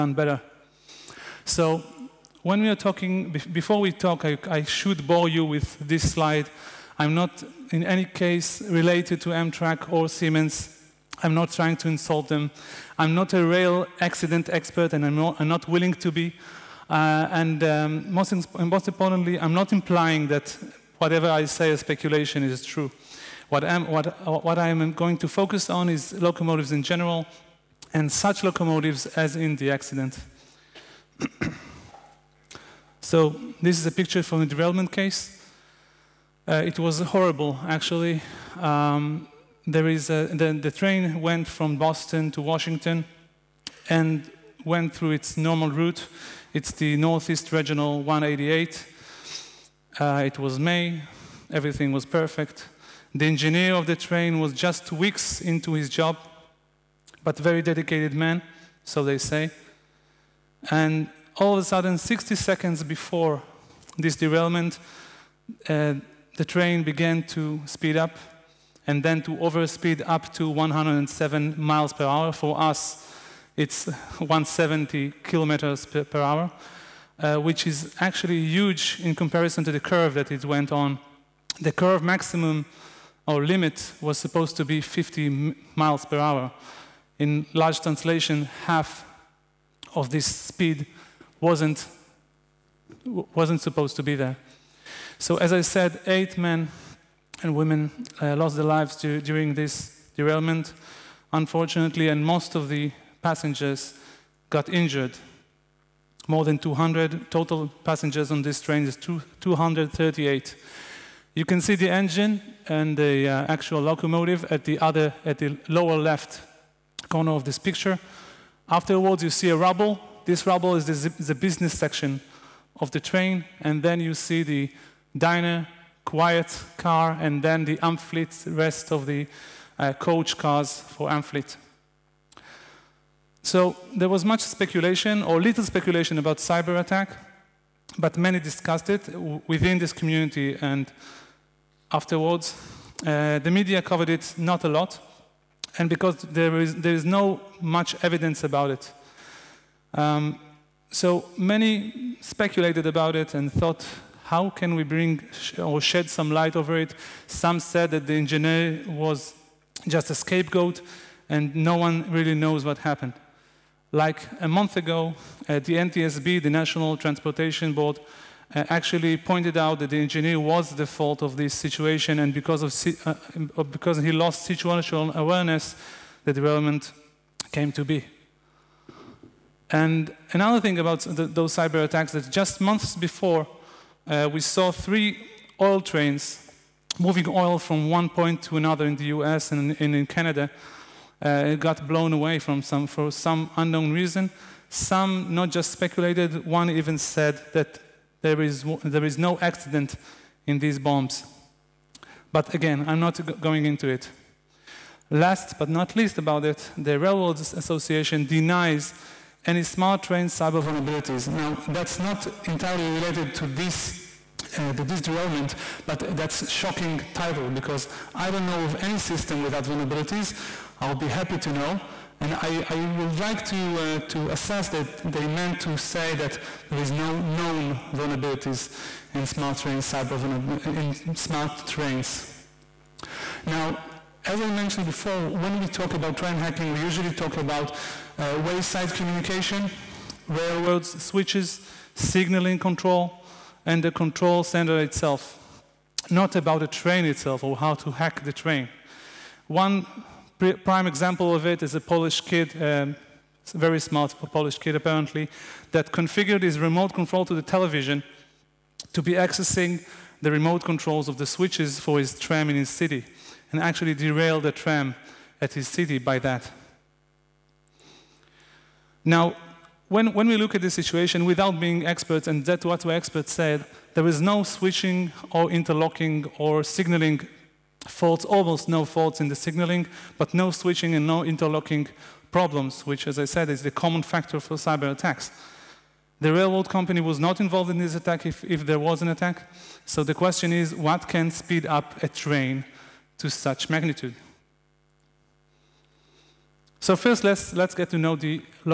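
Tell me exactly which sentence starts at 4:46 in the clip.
The railroad company was not involved in this attack if, if there was an attack.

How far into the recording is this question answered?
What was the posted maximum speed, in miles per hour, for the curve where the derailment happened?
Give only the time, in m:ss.
1:24.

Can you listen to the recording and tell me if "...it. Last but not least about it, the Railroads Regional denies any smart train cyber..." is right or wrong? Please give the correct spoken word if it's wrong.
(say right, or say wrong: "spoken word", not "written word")
wrong: "Association", not "Regional".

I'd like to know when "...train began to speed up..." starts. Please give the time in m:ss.
1:06.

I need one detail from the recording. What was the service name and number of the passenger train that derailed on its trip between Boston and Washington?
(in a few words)
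Northeast Regional 188.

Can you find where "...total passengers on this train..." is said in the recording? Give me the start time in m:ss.
1:47.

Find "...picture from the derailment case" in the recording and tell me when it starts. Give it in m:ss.
0:33.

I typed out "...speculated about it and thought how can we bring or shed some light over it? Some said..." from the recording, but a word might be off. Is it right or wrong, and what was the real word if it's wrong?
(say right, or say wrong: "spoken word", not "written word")
right.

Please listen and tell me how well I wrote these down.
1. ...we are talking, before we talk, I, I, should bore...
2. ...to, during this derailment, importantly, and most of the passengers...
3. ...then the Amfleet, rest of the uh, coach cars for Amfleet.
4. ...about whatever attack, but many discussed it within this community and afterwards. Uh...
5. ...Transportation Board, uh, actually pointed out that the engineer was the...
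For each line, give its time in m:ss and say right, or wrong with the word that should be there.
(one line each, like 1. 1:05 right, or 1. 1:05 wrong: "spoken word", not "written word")
1. 0:02 right
2. 1:38 wrong: "unfortunately", not "importantly"
3. 2:07 right
4. 2:16 wrong: "cyber", not "whatever"
5. 2:46 right.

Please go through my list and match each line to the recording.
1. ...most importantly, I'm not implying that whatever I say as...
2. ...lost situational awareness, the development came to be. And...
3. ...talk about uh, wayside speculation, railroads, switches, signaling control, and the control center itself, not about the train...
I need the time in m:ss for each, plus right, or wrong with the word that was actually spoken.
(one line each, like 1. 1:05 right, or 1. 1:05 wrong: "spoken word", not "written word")
1. 0:18 right
2. 2:54 right
3. 3:57 wrong: "communication", not "speculation".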